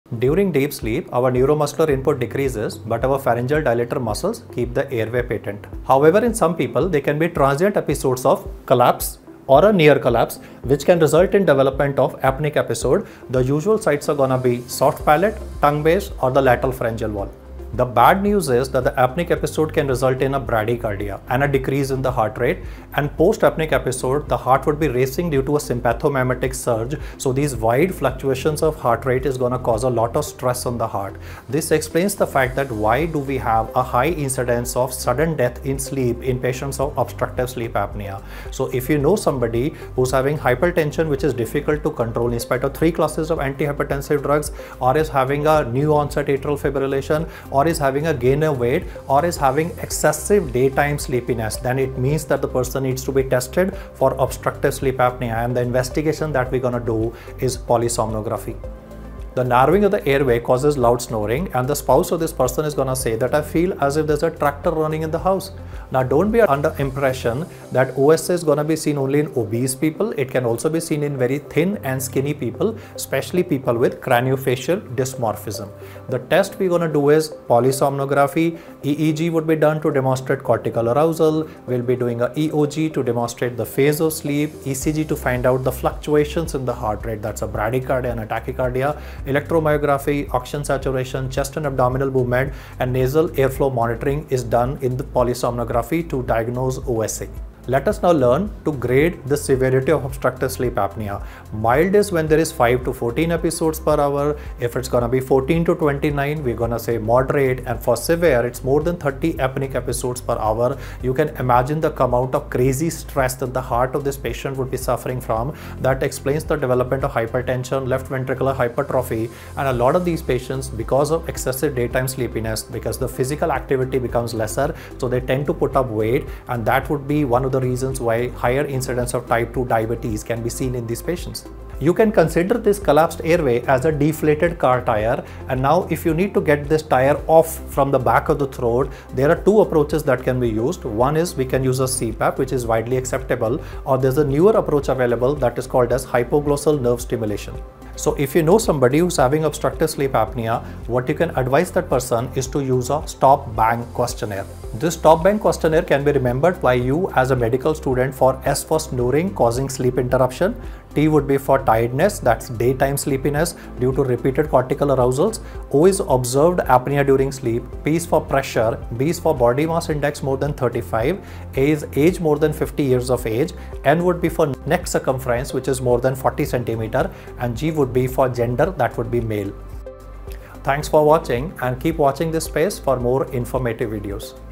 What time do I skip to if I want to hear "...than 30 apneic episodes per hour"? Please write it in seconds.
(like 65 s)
108 s.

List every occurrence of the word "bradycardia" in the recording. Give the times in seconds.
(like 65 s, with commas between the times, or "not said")
20 s, 87 s.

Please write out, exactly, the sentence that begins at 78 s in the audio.
EEG would be done to demonstrate cortical arousal.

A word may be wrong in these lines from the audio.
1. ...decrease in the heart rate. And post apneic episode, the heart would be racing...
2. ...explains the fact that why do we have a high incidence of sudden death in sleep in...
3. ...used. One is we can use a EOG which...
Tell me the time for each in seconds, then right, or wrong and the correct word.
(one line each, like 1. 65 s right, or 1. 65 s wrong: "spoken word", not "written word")
1. 21 s right
2. 31 s right
3. 140 s wrong: "CPAP", not "EOG".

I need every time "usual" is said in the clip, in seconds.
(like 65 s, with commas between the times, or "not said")
13 s.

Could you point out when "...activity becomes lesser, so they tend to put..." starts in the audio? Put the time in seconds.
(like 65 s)
123 s.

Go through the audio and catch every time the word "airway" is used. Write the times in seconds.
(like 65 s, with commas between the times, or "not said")
4 s, 60 s, 133 s.